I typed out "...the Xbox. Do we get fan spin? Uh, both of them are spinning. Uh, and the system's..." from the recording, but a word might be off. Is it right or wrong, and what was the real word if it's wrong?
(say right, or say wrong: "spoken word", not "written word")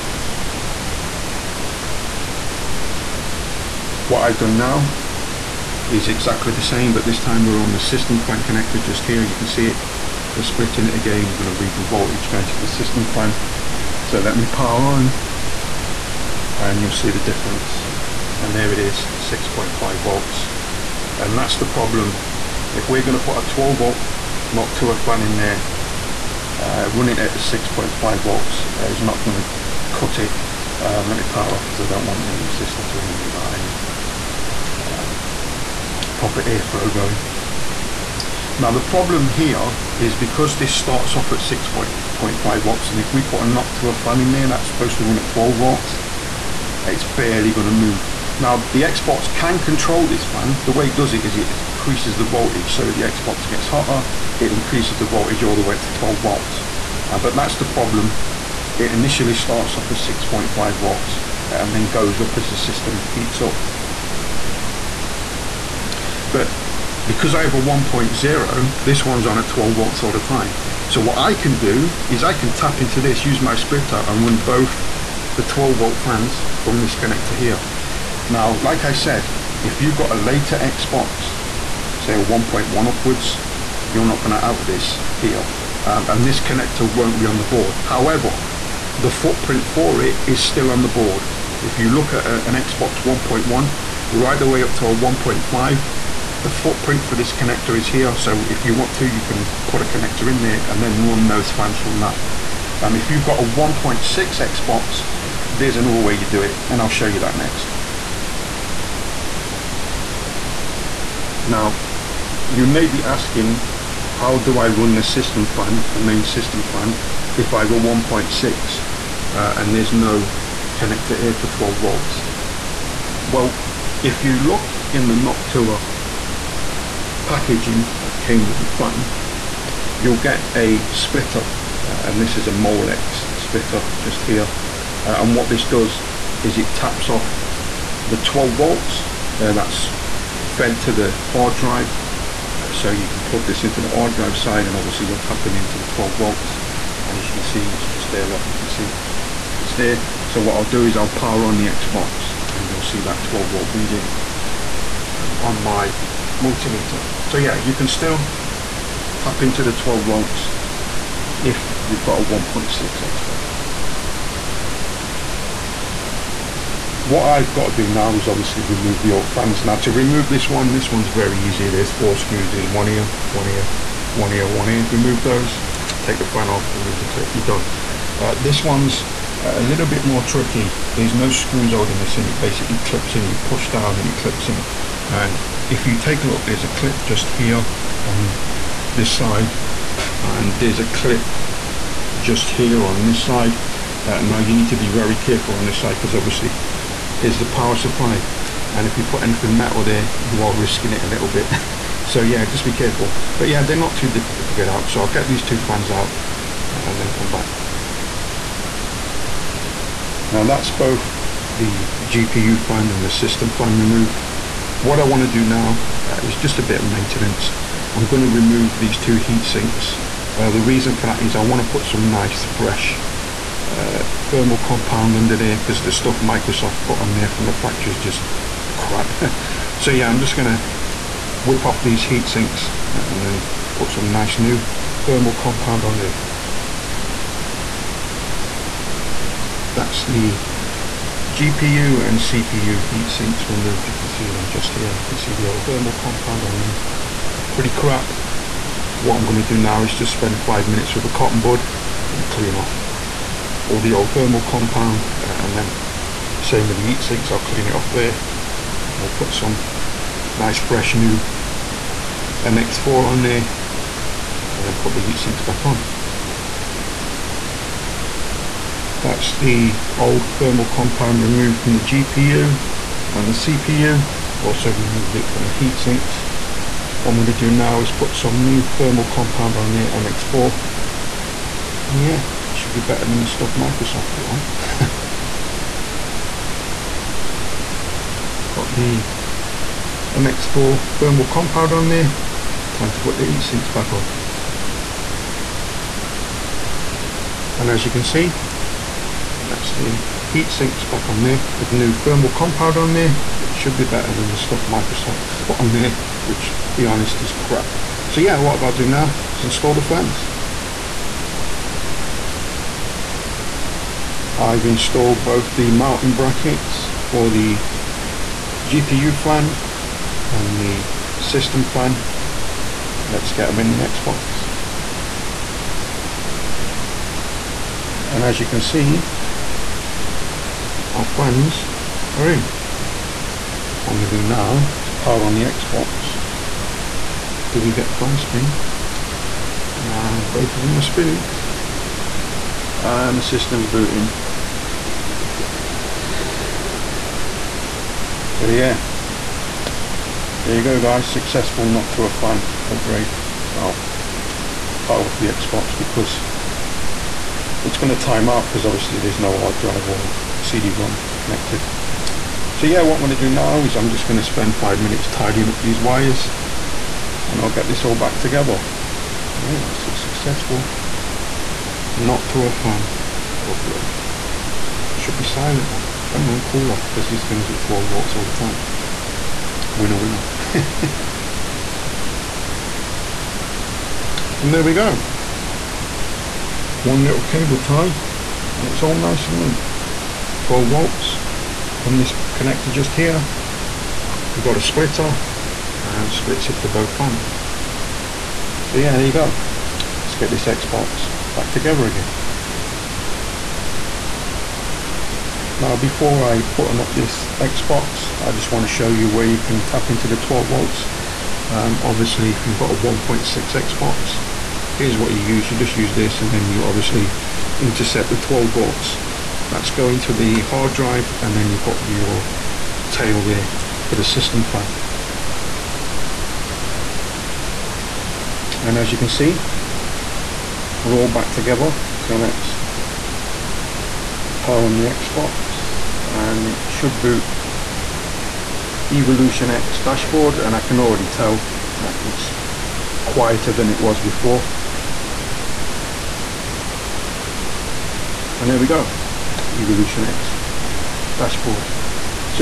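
right.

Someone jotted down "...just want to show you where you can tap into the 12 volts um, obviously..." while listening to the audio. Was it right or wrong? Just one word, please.
right.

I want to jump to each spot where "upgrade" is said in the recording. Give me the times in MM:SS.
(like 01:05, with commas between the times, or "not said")
05:52, 06:13.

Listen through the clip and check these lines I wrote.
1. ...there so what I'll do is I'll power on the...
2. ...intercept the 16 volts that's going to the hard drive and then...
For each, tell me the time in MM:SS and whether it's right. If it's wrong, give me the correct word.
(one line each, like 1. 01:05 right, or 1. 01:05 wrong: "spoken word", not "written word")
1. 02:29 right
2. 06:57 wrong: "12", not "16".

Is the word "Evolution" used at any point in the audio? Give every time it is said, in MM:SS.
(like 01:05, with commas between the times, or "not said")
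07:18, 07:29.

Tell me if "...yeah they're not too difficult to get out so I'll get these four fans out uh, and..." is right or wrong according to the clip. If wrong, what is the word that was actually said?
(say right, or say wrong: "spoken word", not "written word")
wrong: "two", not "four".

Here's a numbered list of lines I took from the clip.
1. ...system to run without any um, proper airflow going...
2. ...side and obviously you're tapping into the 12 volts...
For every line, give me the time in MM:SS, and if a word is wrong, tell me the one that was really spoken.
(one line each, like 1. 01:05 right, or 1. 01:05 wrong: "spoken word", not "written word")
1. 00:32 right
2. 02:24 right.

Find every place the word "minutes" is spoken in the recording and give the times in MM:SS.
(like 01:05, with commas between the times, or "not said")
04:10, 06:04.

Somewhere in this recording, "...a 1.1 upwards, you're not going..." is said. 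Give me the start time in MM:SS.
01:22.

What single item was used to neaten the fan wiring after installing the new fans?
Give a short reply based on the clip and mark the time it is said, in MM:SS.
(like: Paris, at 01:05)
cable tie, at 06:27.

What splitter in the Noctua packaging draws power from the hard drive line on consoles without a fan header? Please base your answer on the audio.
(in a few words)
Molex splitter.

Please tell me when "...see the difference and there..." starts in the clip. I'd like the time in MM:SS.
00:16.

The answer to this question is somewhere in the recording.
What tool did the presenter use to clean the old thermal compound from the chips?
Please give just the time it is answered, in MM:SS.
04:11.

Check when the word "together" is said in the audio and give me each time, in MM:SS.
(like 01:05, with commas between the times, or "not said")
06:08, 06:41, 07:11.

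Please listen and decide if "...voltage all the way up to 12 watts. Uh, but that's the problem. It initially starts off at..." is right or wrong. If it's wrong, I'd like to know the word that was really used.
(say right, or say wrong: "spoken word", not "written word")
right.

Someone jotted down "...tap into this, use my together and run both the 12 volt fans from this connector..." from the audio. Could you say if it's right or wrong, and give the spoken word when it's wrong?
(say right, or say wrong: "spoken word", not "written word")
wrong: "splitter", not "together".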